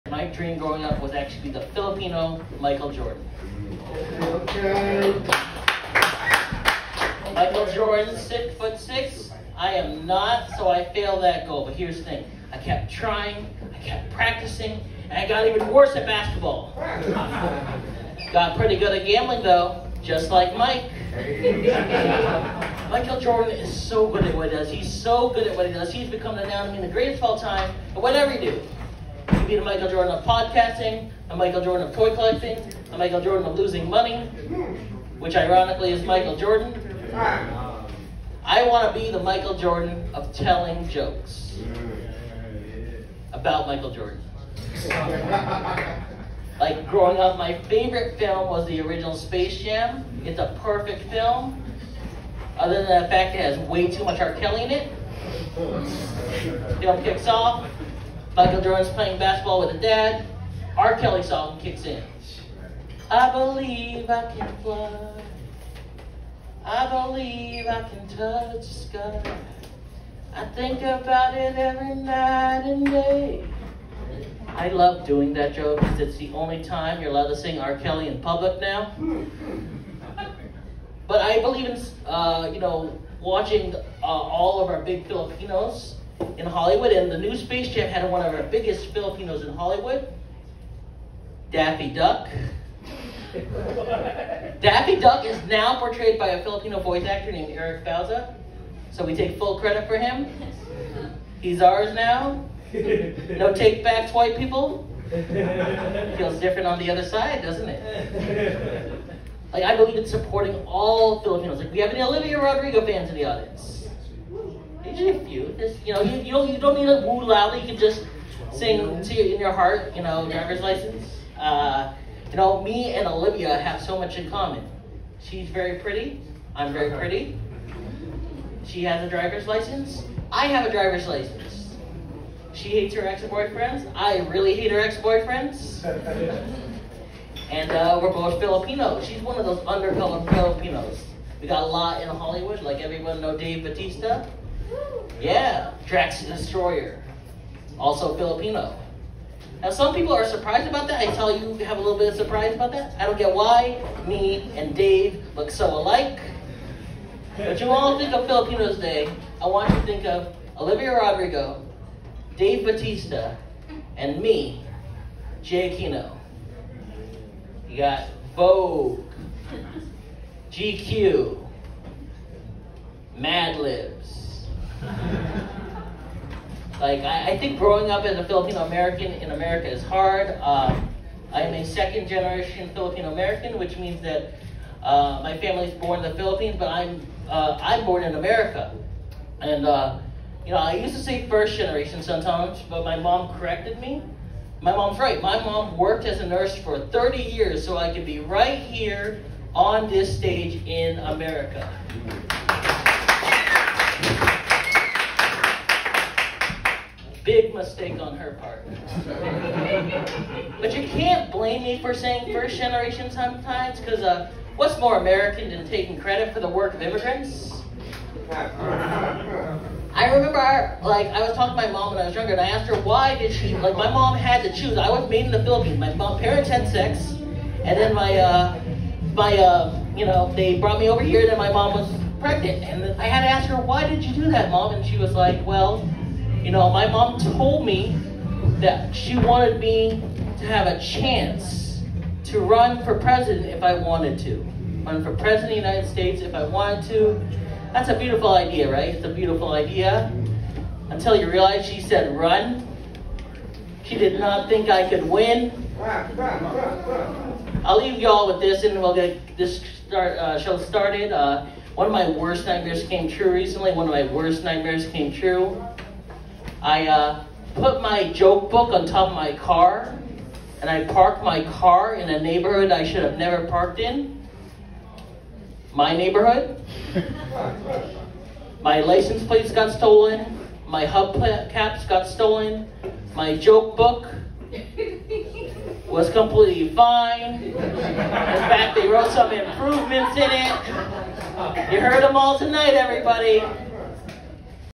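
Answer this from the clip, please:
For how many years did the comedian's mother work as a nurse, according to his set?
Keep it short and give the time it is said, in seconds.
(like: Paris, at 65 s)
30, at 196 s.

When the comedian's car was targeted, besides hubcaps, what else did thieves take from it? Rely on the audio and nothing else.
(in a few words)
license plates.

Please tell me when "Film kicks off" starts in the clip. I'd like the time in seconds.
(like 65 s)
56 s.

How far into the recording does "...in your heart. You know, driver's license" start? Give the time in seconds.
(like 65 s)
119 s.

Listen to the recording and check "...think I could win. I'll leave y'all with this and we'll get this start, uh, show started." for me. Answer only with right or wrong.
right.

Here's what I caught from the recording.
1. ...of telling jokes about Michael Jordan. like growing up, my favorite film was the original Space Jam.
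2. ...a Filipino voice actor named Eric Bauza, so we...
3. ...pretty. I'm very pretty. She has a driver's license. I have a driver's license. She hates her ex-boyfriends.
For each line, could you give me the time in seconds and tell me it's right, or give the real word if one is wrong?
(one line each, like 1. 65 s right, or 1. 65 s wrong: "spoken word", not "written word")
1. 40 s right
2. 96 s right
3. 125 s right.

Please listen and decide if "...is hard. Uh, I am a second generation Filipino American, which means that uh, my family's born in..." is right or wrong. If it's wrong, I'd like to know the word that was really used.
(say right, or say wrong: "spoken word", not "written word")
right.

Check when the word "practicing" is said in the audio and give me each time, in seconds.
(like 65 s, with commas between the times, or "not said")
14 s.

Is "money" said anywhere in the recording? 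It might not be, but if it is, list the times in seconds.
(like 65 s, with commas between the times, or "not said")
33 s.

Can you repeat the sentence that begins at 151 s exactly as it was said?
I tell you, have a little bit of surprise about that.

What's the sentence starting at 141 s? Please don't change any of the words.
We got a lot in Hollywood, like everyone know Dave Bautista.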